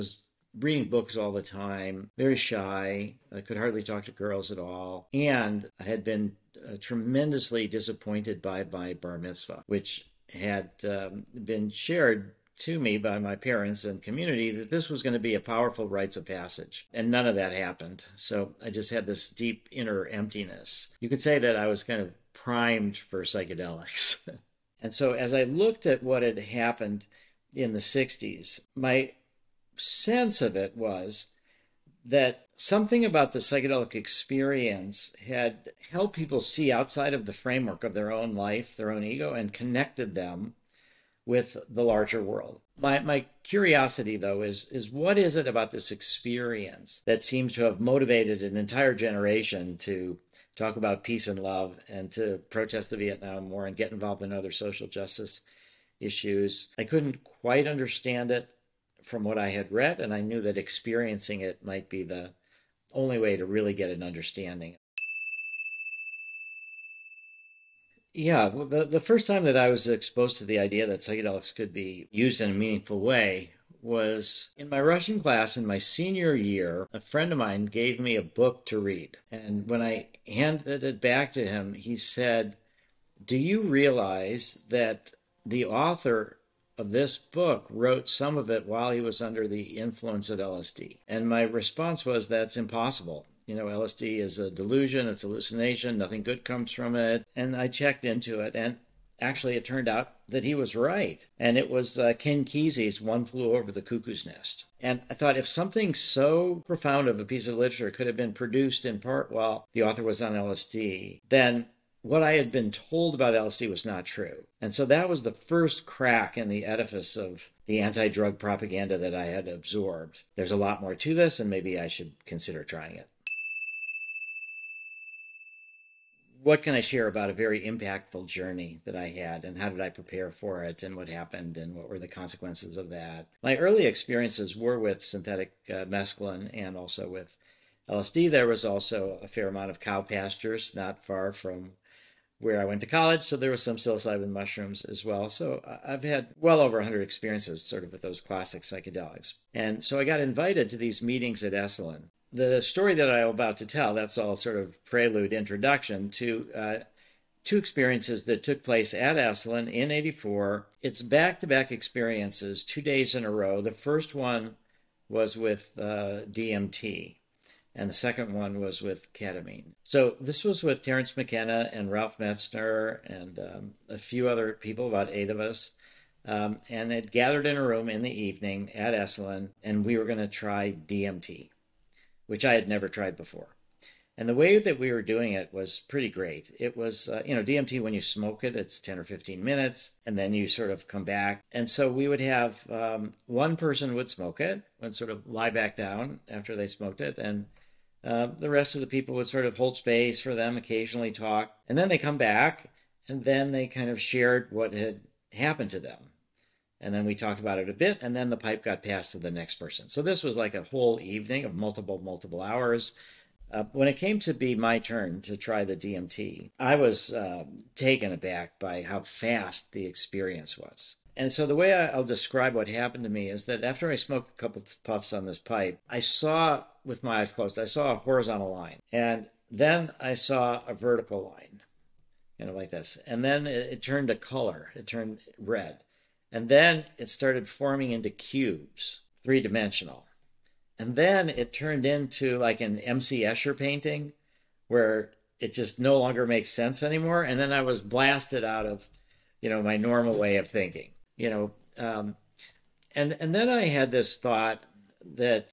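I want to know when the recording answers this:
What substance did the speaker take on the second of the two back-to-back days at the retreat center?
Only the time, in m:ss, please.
2:49.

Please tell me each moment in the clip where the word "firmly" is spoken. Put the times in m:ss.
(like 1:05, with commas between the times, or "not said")
not said.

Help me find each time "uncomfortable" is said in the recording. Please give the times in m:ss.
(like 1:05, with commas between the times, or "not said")
not said.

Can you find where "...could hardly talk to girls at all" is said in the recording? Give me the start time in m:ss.
0:03.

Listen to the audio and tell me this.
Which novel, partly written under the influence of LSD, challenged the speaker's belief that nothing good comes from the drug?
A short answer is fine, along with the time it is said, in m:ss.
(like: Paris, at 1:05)
One Flew Over the Cuckoo's Nest, at 1:42.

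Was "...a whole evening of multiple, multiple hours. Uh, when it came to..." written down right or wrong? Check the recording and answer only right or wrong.
right.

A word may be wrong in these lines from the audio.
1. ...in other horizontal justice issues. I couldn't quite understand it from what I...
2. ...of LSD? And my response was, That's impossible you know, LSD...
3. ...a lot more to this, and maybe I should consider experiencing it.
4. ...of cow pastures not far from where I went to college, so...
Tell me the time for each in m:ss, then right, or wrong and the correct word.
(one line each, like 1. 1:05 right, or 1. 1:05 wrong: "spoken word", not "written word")
1. 0:54 wrong: "social", not "horizontal"
2. 1:30 right
3. 2:00 wrong: "trying", not "experiencing"
4. 2:19 right.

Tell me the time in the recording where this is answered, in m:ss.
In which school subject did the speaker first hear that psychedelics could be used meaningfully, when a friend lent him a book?
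1:14.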